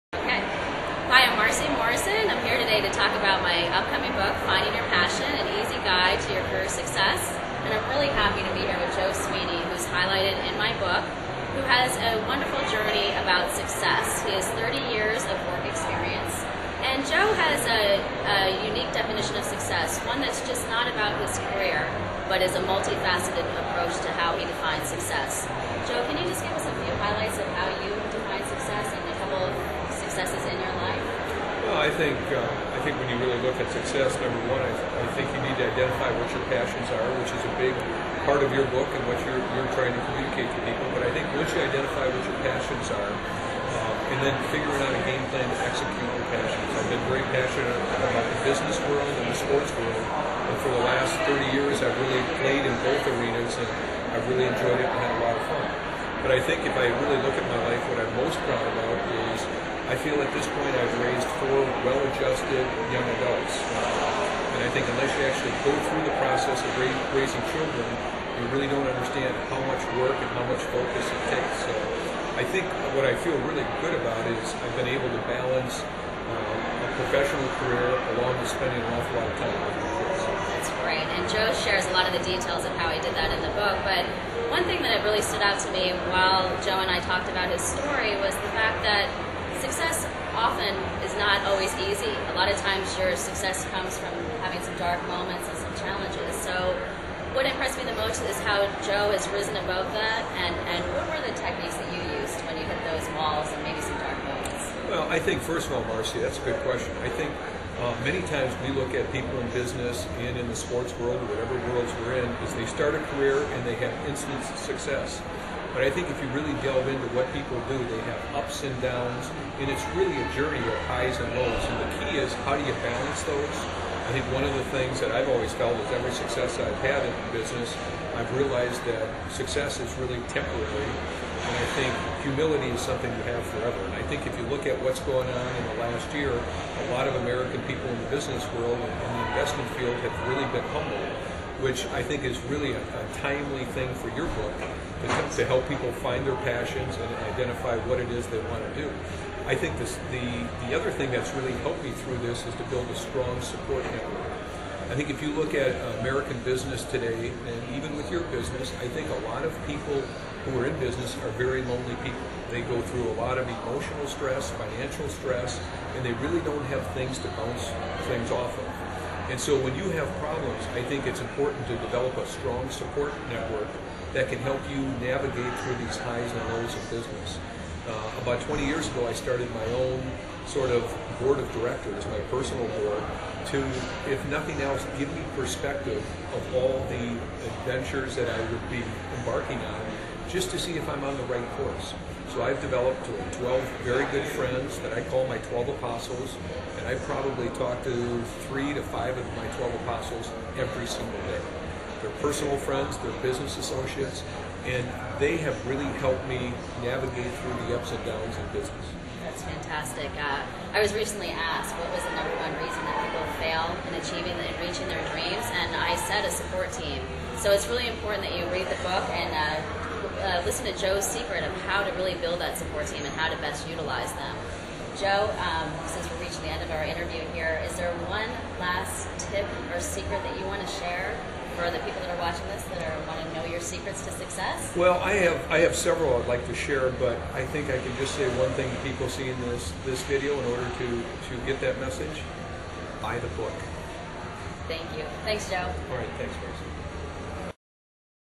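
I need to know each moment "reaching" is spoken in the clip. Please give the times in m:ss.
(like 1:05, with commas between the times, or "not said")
3:34, 3:46.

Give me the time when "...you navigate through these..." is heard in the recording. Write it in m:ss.
2:54.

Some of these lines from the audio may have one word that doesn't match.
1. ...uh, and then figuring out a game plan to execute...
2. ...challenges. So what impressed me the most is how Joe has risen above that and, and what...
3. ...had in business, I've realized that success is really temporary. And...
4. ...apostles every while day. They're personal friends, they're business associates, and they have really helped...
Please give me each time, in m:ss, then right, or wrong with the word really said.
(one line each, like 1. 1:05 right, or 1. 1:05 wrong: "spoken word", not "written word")
1. 0:43 right
2. 1:35 right
3. 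2:06 right
4. 3:19 wrong: "single", not "while".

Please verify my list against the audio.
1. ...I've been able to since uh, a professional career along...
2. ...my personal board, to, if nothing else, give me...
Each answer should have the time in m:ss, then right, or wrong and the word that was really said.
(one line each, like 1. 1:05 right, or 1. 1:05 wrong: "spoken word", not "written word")
1. 1:14 wrong: "balance", not "since"
2. 3:02 right.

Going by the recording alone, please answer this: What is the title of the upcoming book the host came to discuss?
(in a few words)
Finding Your Passion.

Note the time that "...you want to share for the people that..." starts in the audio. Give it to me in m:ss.
3:50.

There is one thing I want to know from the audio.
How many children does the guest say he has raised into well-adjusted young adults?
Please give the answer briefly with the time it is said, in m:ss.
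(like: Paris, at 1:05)
4, at 1:01.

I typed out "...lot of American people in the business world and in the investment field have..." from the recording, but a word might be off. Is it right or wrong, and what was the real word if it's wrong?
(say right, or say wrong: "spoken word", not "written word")
right.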